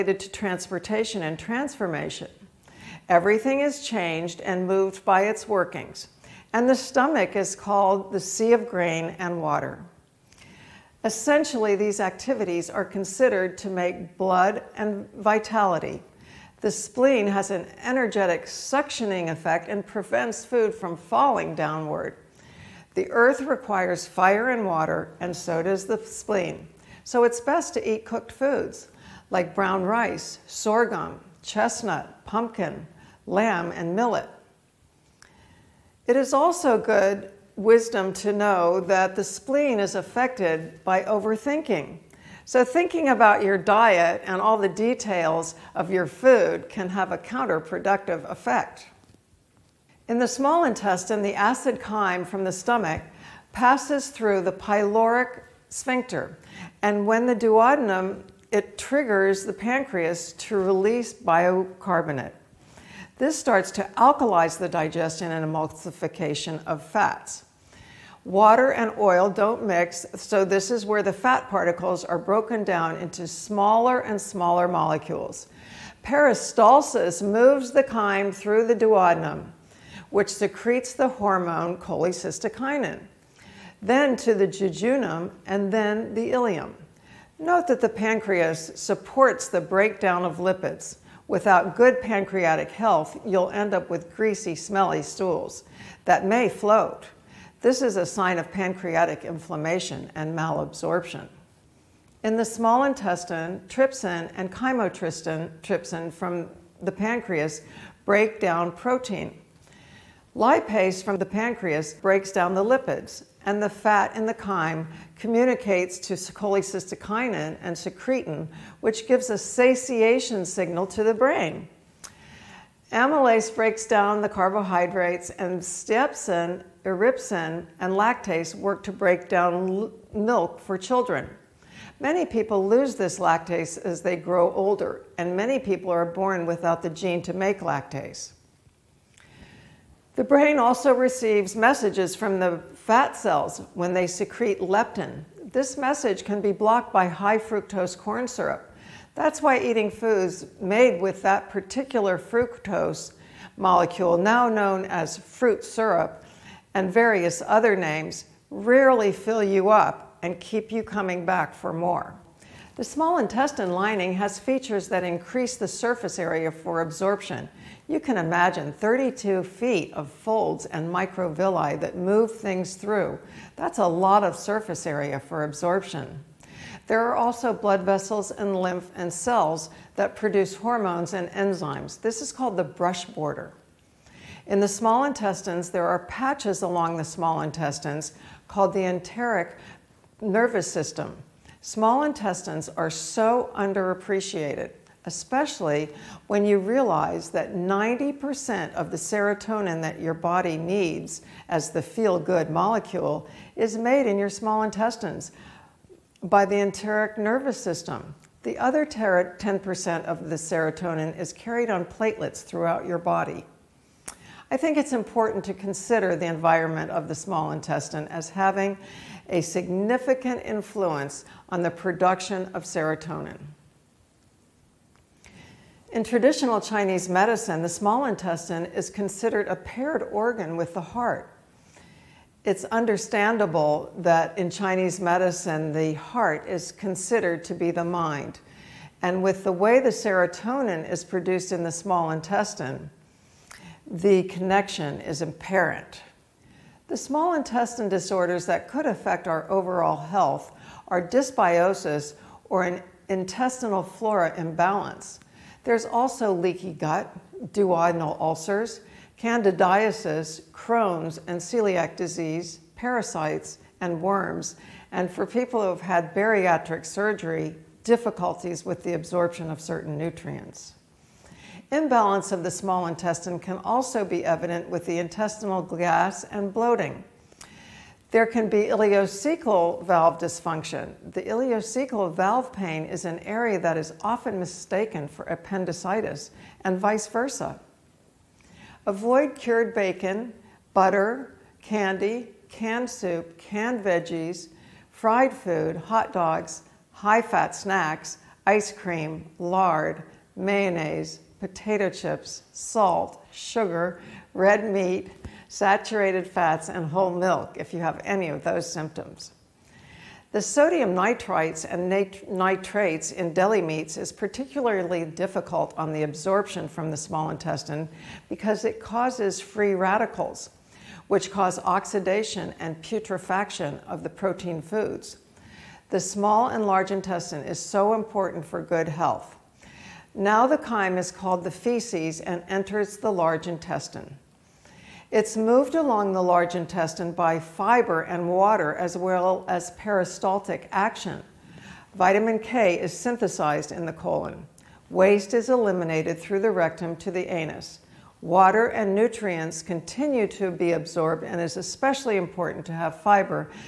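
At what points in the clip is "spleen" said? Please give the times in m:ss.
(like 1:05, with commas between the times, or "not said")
0:16, 0:25, 0:39.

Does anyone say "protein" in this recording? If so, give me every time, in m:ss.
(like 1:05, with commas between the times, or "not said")
1:48, 5:24.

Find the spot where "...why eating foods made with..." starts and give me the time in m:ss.
2:29.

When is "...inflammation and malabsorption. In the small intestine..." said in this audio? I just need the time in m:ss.
1:39.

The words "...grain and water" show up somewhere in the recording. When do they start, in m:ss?
0:08.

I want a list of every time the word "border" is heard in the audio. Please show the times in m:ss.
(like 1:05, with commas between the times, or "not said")
3:03.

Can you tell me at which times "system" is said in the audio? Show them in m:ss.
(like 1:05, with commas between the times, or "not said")
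3:10, 3:27.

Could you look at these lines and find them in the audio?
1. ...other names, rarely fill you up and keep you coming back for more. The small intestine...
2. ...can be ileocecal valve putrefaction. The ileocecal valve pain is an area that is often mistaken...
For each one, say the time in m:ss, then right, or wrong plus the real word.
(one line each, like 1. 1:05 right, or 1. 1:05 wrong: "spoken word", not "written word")
1. 2:37 right
2. 4:38 wrong: "dysfunction", not "putrefaction".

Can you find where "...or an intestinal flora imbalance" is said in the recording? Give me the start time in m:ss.
4:12.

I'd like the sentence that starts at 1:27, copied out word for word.
Note that the pancreas supports the breakdown of lipids.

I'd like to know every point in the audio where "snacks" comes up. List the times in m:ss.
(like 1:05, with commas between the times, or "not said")
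4:57.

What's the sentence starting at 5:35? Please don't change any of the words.
It's moved along the large intestine by fiber and water as well as peristaltic action.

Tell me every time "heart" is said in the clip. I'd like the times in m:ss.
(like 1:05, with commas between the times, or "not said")
3:50, 3:55.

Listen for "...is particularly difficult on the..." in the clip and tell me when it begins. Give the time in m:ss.
5:13.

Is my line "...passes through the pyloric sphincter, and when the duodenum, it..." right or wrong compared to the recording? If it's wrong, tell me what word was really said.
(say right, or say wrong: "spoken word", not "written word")
right.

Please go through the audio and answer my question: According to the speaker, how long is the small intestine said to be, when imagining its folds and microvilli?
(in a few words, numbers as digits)
32 feet.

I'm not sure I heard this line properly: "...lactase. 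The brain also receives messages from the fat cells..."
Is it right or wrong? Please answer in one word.
right.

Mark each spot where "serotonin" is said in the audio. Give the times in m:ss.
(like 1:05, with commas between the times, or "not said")
3:18, 3:30, 3:42, 3:59.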